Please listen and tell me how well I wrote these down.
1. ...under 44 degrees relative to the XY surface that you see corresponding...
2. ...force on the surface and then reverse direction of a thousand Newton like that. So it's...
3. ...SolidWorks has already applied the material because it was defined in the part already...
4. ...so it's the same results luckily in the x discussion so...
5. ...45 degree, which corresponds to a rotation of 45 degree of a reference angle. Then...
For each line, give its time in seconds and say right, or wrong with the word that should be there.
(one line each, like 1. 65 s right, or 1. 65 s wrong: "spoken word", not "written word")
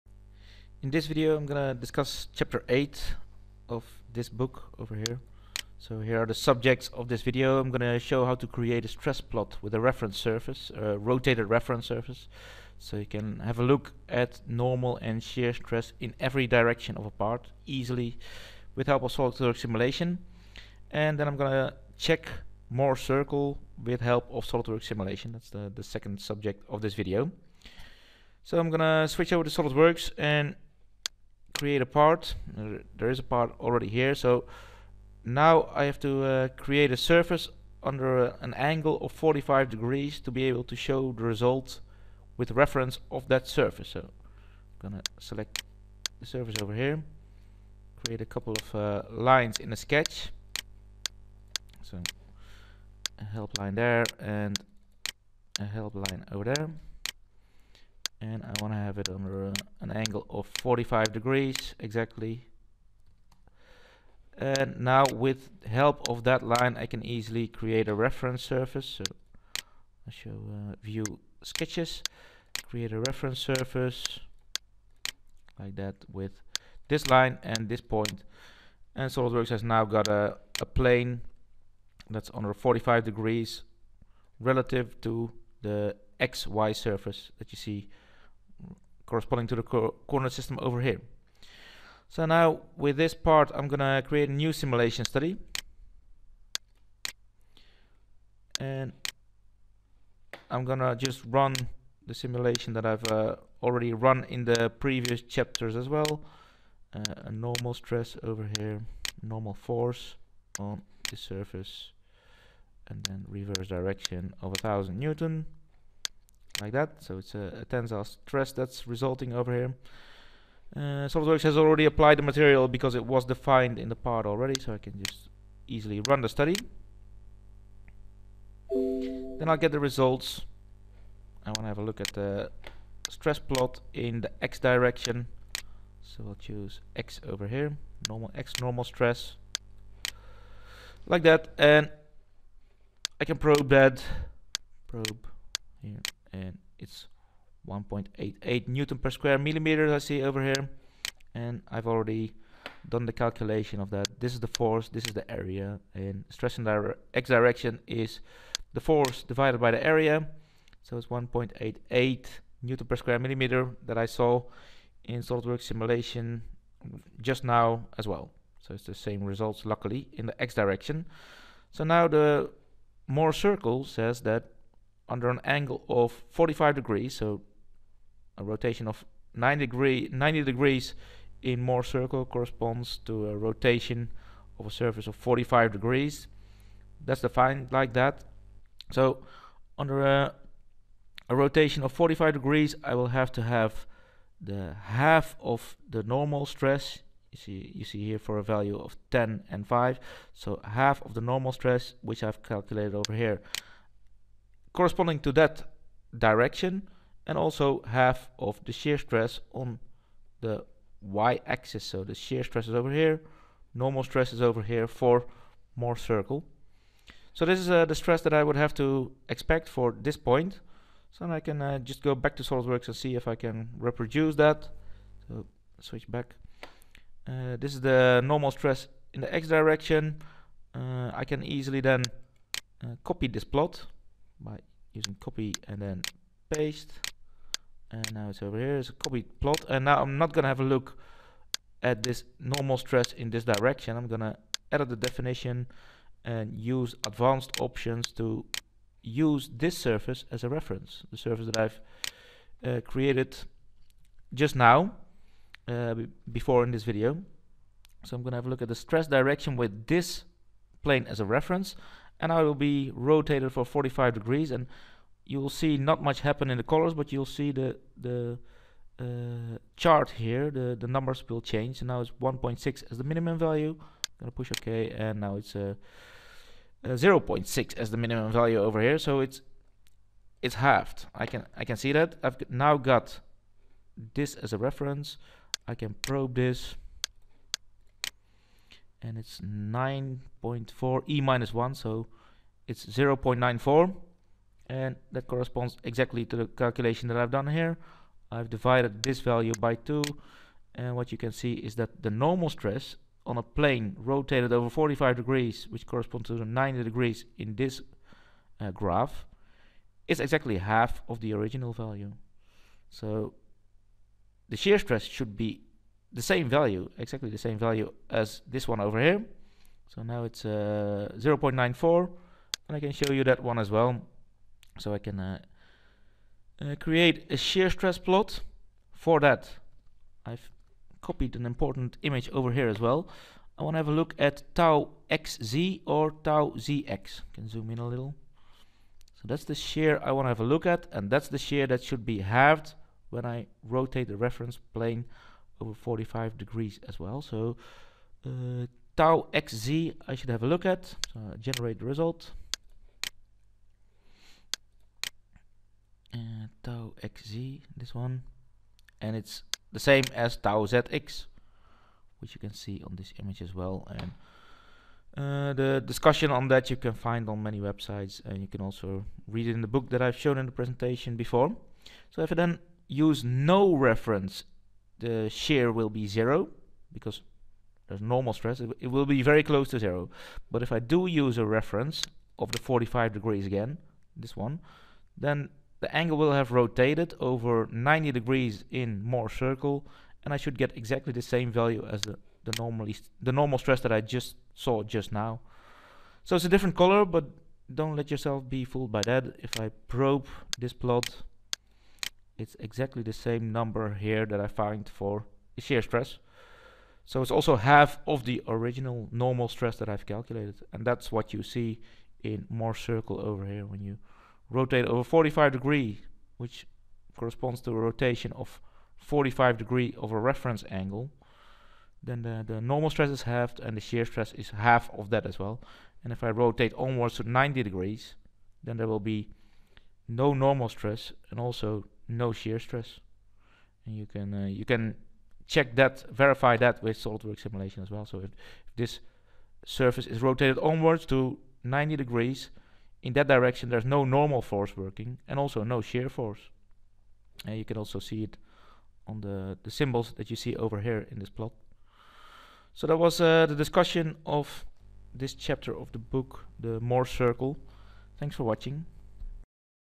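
1. 82 s wrong: "45", not "44"
2. 109 s right
3. 121 s right
4. 168 s wrong: "direction", not "discussion"
5. 415 s right.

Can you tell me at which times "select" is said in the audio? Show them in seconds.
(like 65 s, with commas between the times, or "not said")
45 s.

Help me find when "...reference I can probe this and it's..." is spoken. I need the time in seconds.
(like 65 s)
284 s.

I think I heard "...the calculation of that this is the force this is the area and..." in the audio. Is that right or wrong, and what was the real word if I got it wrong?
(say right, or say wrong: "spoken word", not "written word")
right.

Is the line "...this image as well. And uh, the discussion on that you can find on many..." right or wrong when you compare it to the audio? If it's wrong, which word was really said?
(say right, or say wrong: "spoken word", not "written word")
right.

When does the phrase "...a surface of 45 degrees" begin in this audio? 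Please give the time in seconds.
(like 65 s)
184 s.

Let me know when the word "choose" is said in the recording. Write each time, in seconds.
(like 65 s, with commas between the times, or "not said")
136 s.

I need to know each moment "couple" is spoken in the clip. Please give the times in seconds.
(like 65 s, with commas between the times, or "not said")
48 s.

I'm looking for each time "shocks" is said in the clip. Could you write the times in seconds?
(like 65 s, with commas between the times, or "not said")
not said.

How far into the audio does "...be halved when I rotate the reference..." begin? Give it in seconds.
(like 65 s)
342 s.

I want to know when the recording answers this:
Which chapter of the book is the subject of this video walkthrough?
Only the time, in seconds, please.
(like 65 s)
2 s.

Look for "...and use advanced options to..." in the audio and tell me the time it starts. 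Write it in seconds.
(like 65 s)
246 s.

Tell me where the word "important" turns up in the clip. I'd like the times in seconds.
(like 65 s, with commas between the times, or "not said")
331 s.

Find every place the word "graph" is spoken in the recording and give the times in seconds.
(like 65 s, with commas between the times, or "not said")
308 s.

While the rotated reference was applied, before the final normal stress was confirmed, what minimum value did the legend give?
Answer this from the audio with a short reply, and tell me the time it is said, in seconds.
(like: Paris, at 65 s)
1.6, at 272 s.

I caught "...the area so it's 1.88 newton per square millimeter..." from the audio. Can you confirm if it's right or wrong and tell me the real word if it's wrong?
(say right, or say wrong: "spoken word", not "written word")
right.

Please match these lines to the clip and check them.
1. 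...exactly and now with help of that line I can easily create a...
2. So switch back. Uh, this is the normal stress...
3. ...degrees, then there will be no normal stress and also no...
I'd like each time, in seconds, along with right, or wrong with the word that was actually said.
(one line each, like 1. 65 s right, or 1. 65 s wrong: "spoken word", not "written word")
1. 61 s right
2. 225 s right
3. 427 s right.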